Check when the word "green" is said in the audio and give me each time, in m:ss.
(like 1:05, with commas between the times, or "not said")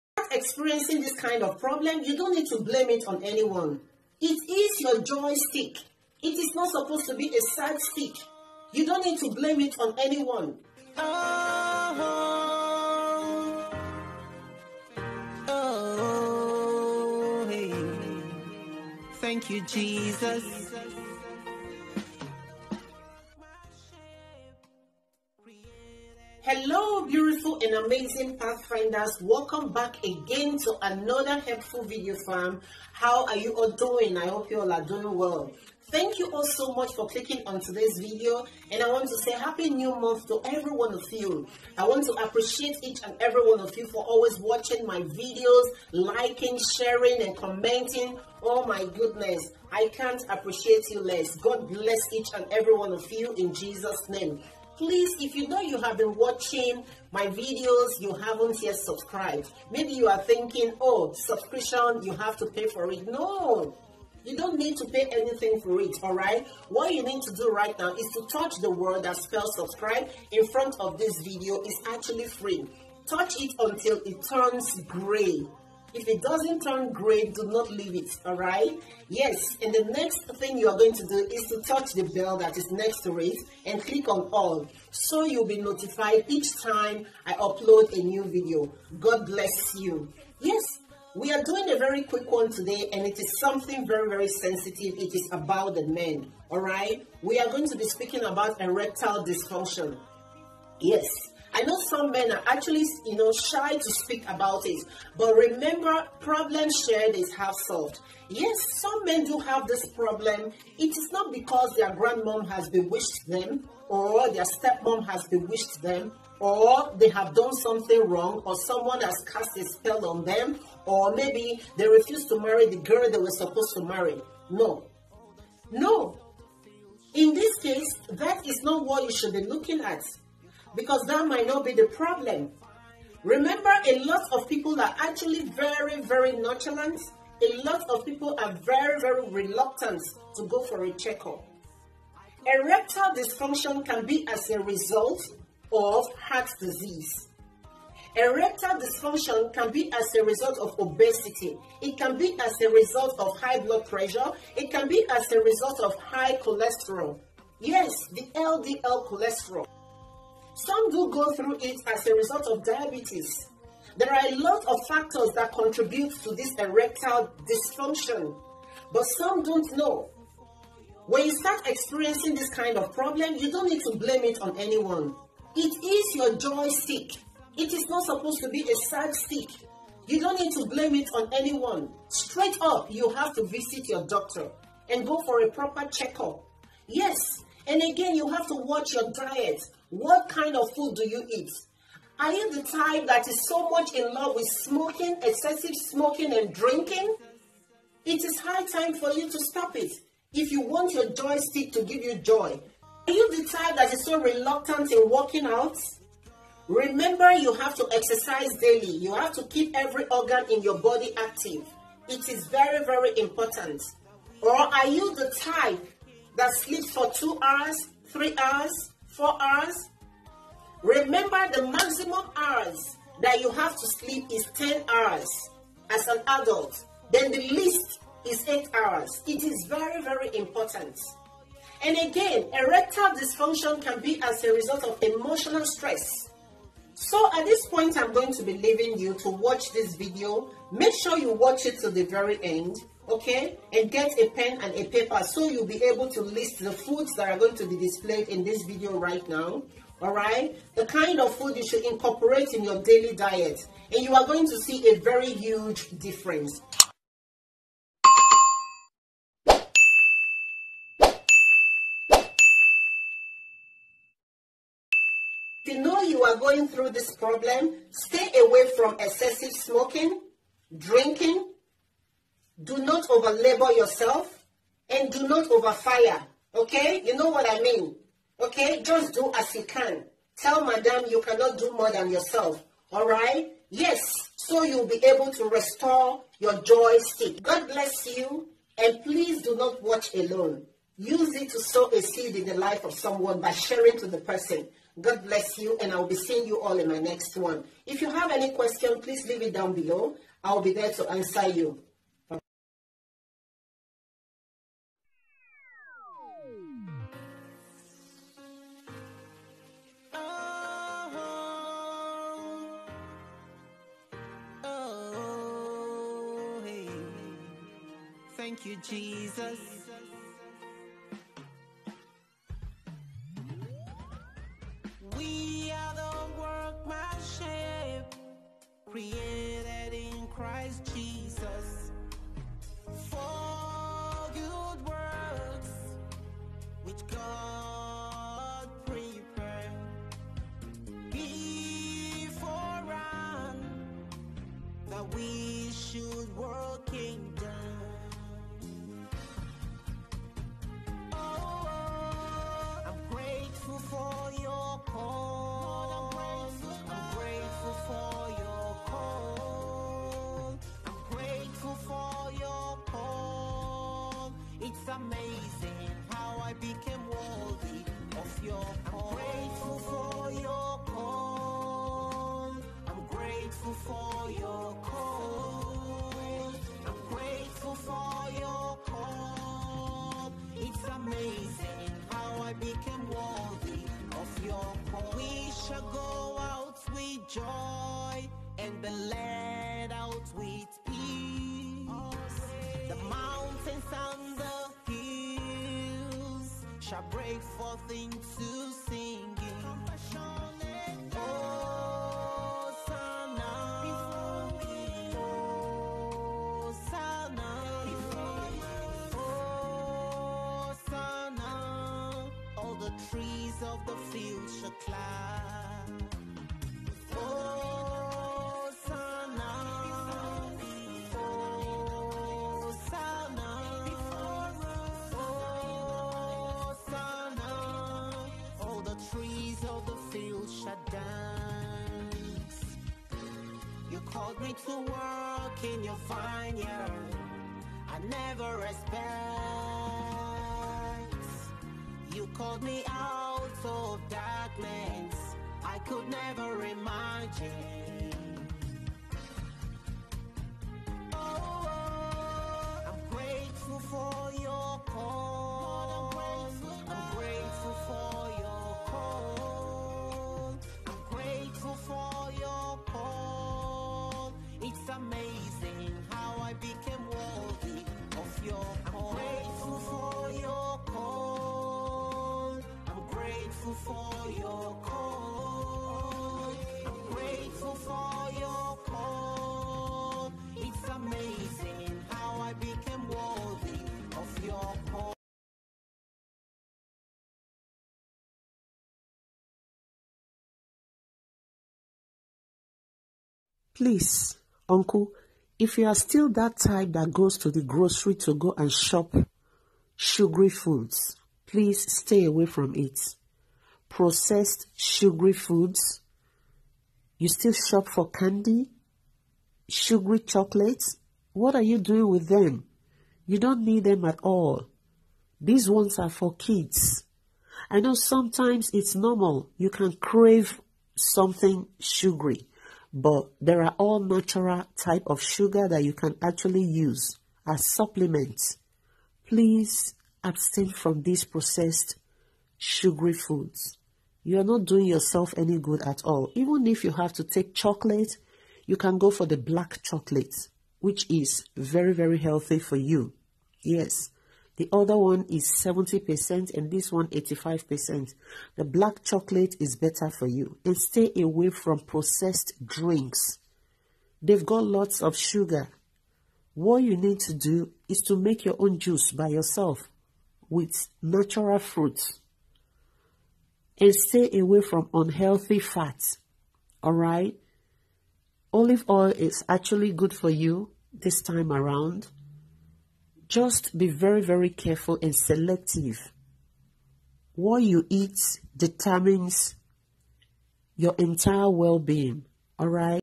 1:16.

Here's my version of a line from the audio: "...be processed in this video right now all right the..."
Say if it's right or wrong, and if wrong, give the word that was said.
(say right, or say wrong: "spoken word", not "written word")
wrong: "displayed", not "processed".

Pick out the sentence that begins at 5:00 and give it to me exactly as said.
I'll be there to answer you.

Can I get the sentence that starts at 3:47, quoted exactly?
Then the least is 8 hours.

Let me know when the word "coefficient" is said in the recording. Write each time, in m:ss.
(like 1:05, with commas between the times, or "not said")
not said.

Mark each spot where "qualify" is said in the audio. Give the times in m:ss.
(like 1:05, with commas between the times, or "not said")
not said.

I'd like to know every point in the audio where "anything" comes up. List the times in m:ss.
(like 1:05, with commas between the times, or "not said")
1:05.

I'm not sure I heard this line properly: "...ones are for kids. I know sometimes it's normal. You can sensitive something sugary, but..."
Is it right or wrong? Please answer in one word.
wrong.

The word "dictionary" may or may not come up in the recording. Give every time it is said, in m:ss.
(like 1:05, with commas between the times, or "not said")
not said.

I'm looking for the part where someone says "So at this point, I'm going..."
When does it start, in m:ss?
3:56.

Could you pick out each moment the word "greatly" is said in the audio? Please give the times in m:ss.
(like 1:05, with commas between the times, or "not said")
not said.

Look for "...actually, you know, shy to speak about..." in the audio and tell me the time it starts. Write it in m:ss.
1:42.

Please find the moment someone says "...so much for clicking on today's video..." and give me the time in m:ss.
0:36.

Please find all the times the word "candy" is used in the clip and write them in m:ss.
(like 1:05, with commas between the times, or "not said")
8:28.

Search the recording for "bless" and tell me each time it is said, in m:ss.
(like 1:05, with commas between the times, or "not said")
0:51, 1:29, 4:47, 4:55.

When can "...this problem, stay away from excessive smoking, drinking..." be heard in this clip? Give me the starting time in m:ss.
4:26.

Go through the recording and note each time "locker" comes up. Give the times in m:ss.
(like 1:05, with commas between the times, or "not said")
not said.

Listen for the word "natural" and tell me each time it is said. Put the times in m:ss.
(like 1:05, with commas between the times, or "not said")
8:43, 9:21.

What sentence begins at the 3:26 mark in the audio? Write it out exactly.
Remember, you have to exercise daily.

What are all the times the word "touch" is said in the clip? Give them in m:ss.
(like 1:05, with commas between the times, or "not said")
1:08, 1:13, 1:21.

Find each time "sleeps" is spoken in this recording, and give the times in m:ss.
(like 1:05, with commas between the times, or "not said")
3:36, 3:43.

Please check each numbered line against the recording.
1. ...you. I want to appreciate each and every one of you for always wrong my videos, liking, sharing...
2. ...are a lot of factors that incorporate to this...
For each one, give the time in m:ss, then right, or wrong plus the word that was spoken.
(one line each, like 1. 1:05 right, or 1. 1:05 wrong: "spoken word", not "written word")
1. 0:41 wrong: "watching", not "wrong"
2. 2:44 wrong: "contribute", not "incorporate".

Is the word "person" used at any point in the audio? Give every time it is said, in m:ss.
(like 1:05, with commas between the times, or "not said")
4:54.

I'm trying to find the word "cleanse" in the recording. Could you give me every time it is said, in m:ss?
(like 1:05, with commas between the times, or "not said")
not said.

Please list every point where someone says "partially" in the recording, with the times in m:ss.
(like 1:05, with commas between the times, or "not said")
not said.